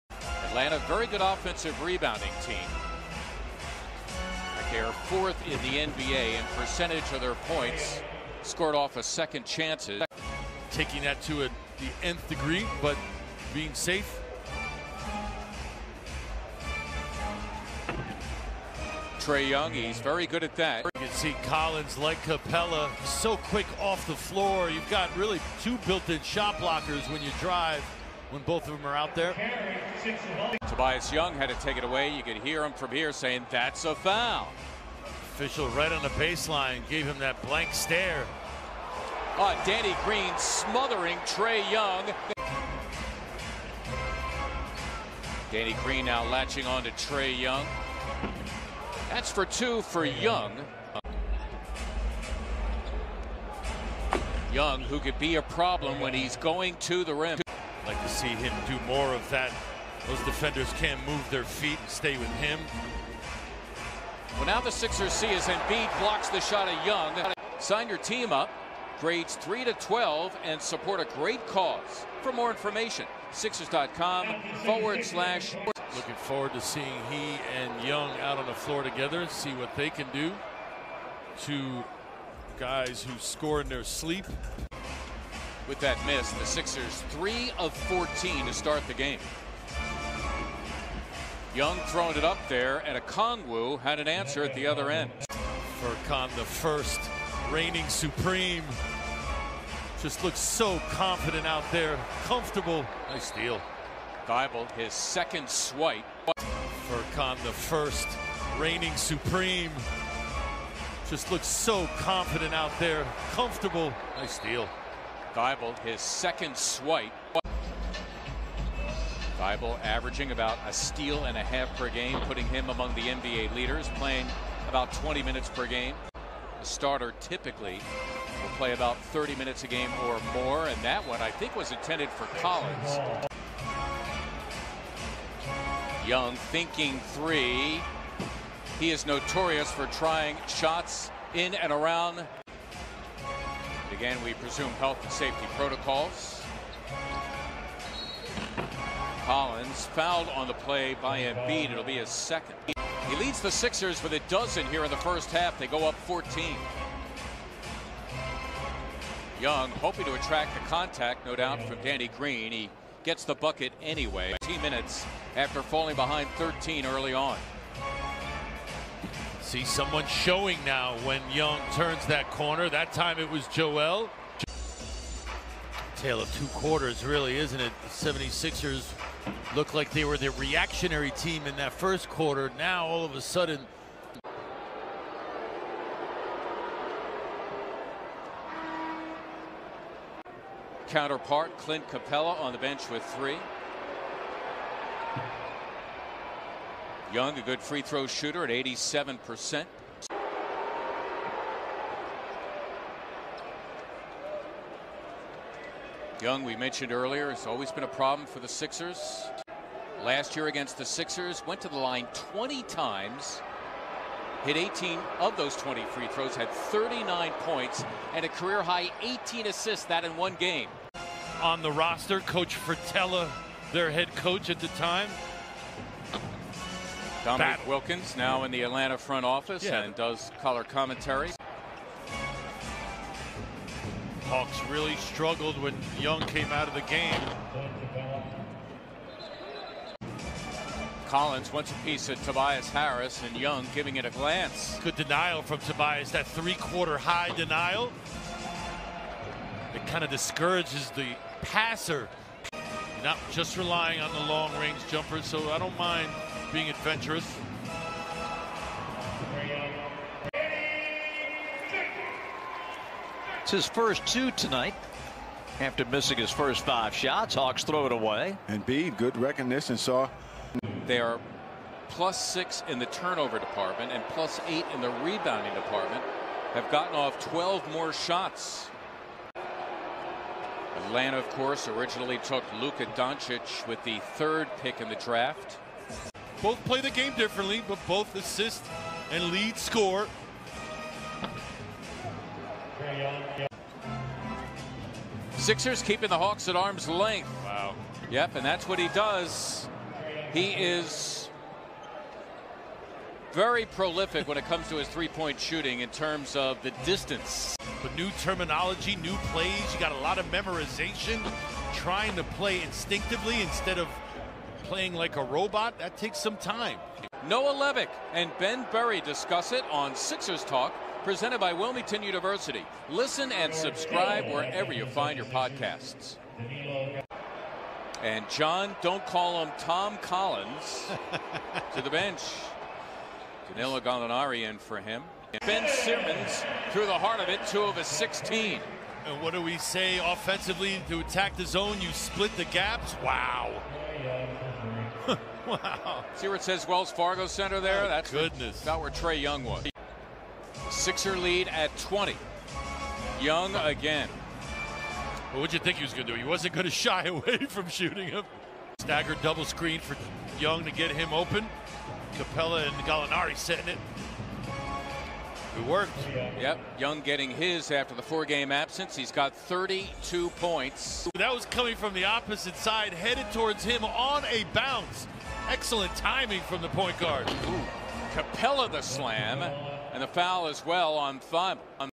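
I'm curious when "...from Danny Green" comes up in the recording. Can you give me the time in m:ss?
2:41.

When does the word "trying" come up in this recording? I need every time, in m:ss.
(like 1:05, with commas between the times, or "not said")
2:19, 5:11.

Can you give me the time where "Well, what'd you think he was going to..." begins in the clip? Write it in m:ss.
5:55.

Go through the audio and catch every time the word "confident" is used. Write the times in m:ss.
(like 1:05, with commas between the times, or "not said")
1:40, 1:51.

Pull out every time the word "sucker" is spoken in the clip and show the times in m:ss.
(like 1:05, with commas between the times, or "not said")
not said.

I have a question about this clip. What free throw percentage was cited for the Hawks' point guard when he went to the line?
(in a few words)
87%.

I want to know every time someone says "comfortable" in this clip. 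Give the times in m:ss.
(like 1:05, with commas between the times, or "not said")
1:42, 1:53.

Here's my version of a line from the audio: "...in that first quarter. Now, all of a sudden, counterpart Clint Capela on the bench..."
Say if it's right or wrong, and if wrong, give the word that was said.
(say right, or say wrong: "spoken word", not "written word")
right.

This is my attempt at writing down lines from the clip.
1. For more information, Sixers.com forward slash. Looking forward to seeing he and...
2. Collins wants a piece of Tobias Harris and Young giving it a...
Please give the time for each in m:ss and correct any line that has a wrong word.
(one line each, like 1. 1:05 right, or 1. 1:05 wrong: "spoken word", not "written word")
1. 1:12 right
2. 4:01 right.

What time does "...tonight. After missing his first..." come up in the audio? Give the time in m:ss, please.
4:24.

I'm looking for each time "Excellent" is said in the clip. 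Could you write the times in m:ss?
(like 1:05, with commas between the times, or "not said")
6:15.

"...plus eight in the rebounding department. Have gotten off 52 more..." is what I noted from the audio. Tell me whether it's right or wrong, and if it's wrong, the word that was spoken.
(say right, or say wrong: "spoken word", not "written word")
wrong: "12", not "52".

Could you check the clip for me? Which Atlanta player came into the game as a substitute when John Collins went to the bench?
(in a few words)
Danilo Gallinari.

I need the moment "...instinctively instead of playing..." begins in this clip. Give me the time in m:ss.
5:12.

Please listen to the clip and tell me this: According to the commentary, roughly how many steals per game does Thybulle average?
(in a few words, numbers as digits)
A steal and a half.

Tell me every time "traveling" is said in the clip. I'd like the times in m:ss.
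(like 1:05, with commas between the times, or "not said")
not said.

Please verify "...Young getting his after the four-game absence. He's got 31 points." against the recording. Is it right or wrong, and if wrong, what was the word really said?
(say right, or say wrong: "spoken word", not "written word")
wrong: "32", not "31".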